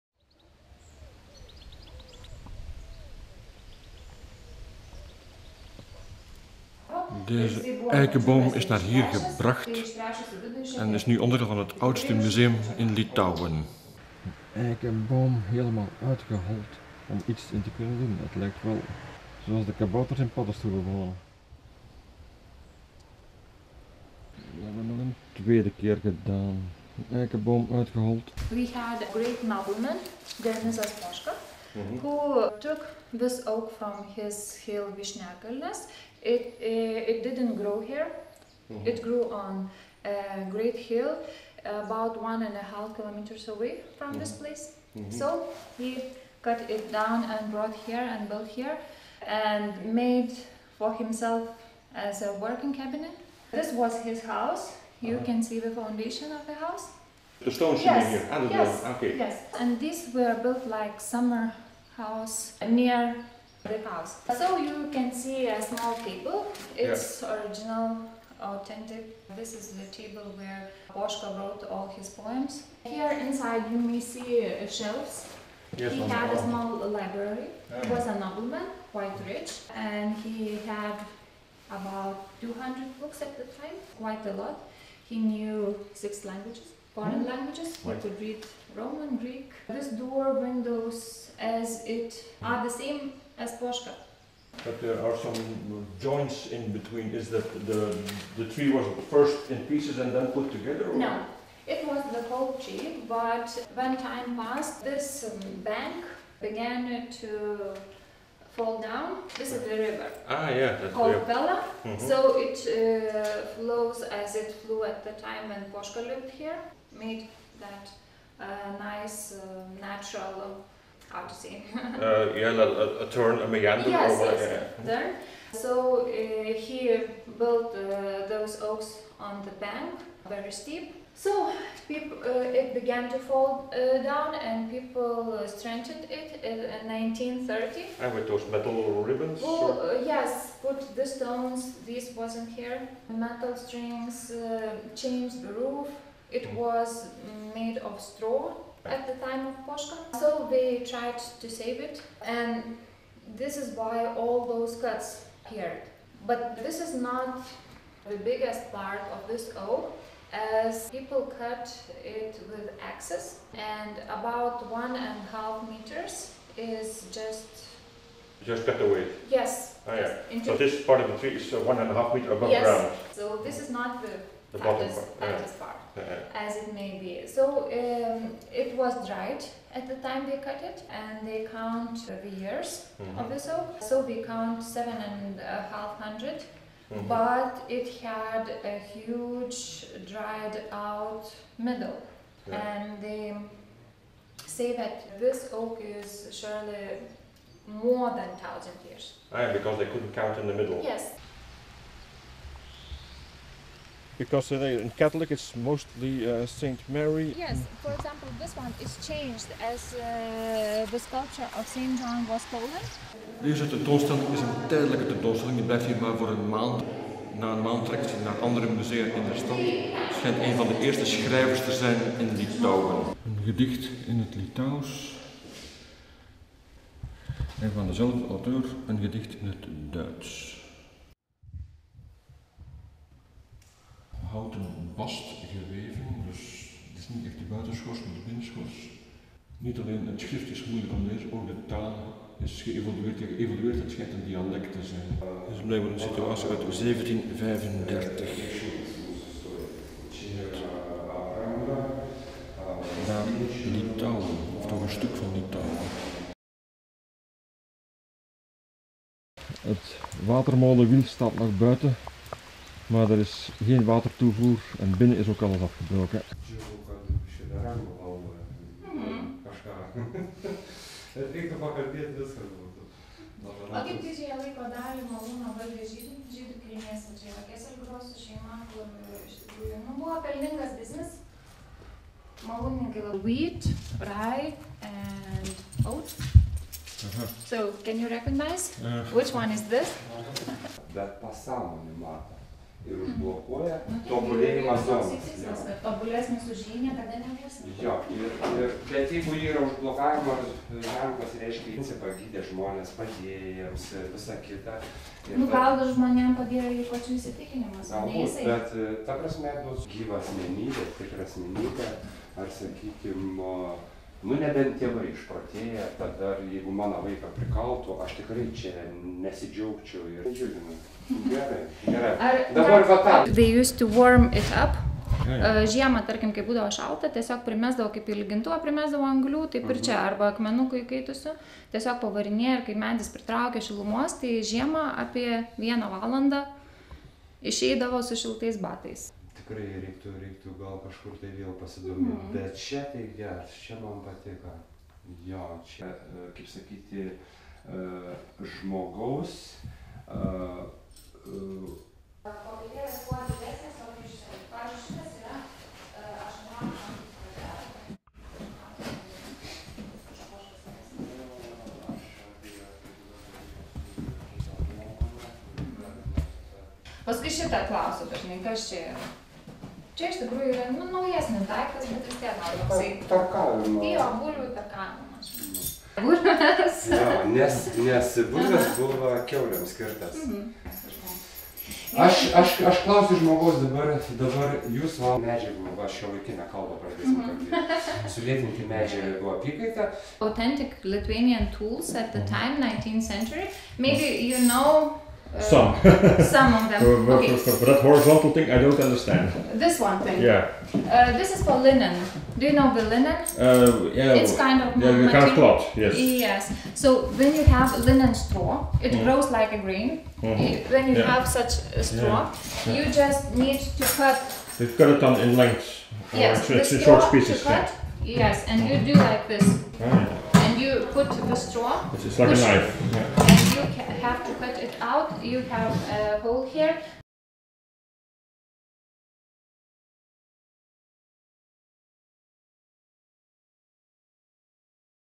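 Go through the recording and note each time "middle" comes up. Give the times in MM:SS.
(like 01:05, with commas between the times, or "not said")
03:11, 03:20.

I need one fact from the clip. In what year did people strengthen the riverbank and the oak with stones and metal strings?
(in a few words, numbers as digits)
1930.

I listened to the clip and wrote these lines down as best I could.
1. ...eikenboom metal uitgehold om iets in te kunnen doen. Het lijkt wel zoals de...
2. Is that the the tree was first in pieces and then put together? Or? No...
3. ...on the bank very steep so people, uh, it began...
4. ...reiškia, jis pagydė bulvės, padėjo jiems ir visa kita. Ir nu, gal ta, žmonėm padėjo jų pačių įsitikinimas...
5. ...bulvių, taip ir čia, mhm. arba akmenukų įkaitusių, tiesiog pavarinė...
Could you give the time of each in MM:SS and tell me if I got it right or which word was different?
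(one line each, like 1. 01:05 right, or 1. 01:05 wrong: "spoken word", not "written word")
1. 00:14 wrong: "helemaal", not "metal"
2. 01:37 right
3. 02:09 right
4. 05:01 wrong: "žmonės", not "bulvės"
5. 05:29 wrong: "anglių", not "bulvių".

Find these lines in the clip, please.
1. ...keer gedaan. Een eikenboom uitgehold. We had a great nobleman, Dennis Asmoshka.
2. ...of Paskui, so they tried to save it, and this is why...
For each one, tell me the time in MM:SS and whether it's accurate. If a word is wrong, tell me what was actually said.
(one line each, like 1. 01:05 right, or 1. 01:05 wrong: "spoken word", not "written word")
1. 00:25 right
2. 02:29 wrong: "Poška", not "Paskui".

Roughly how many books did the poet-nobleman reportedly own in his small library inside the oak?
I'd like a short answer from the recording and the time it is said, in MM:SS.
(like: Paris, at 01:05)
200, at 01:22.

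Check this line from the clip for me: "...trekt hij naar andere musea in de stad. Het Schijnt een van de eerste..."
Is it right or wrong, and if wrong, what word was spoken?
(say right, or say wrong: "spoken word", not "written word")
right.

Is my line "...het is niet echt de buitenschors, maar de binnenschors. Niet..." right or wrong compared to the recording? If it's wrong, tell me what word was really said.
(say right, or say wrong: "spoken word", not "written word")
right.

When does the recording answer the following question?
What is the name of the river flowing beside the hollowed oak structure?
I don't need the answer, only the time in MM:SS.
01:51.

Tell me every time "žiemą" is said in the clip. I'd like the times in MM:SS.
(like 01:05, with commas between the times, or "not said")
05:25, 05:34.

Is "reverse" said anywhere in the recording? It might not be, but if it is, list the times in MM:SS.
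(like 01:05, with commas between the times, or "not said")
not said.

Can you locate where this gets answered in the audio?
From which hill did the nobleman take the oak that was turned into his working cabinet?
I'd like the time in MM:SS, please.
00:34.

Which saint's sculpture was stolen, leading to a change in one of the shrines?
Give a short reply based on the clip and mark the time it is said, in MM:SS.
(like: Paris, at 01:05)
Saint John, at 03:31.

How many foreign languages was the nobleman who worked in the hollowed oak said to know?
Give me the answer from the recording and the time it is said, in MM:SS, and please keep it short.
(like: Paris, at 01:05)
6, at 01:25.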